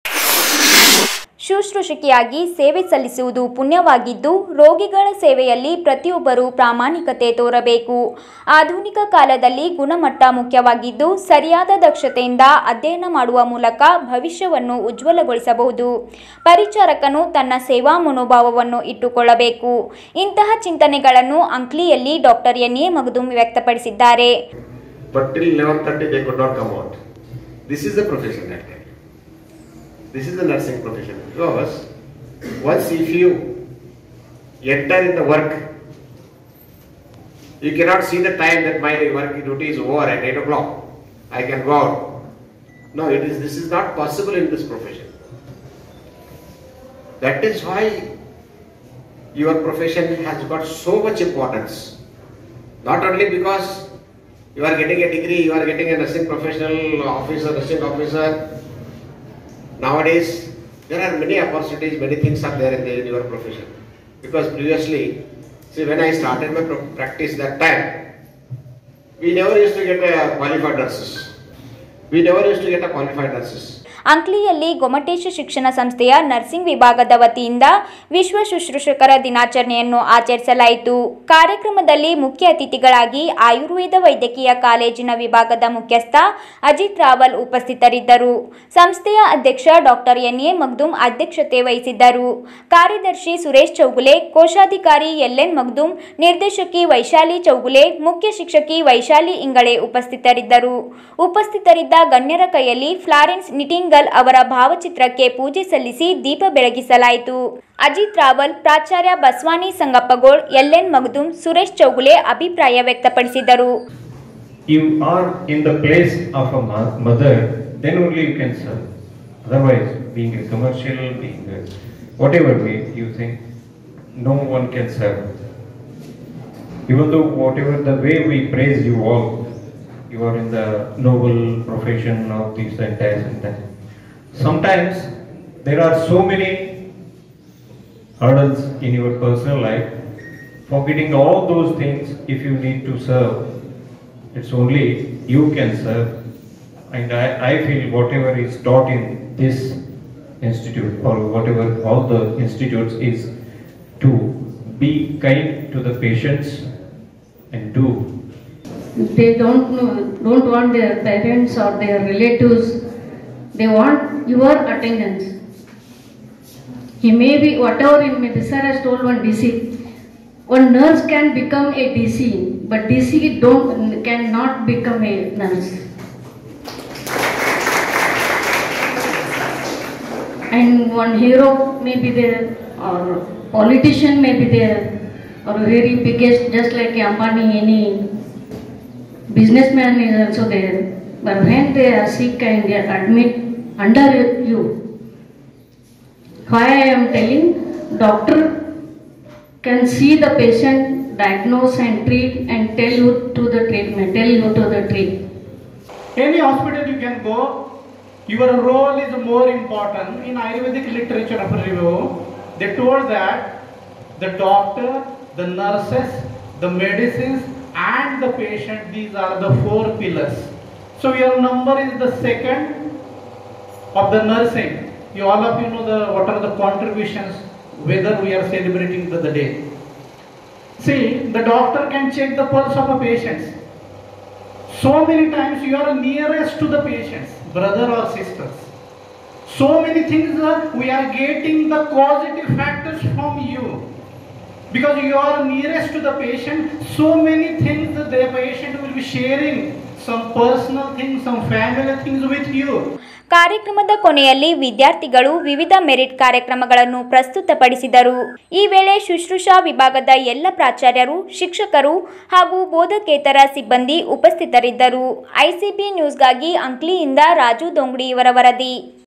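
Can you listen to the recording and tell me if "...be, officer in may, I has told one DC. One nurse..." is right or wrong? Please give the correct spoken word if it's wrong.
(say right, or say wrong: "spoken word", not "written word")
wrong: "whatever", not "officer".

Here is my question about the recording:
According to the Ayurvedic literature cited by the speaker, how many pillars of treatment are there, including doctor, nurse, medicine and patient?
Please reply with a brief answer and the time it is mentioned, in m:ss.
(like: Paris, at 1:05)
4, at 3:39.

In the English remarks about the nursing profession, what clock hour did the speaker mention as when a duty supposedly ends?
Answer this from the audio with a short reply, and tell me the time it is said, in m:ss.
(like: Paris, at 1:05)
8 o'clock, at 0:40.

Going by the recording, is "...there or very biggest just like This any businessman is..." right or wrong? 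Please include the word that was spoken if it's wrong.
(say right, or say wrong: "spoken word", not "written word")
wrong: "Ambani", not "This".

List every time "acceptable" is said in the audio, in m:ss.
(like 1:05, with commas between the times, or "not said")
not said.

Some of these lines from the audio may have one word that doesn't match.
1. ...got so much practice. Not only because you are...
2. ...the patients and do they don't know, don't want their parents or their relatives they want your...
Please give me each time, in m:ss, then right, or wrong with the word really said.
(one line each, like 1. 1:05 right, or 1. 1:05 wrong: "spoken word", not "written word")
1. 0:50 wrong: "importance", not "practice"
2. 2:35 right.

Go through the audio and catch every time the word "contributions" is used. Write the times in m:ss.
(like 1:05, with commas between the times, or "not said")
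3:46.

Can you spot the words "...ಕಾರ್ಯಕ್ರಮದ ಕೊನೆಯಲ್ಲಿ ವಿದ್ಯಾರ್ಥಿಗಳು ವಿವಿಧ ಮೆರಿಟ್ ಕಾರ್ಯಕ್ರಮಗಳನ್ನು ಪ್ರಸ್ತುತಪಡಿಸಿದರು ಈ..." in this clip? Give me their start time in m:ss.
4:13.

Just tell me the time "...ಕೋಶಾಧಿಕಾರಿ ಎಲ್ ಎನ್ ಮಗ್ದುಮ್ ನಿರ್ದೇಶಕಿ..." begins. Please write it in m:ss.
1:34.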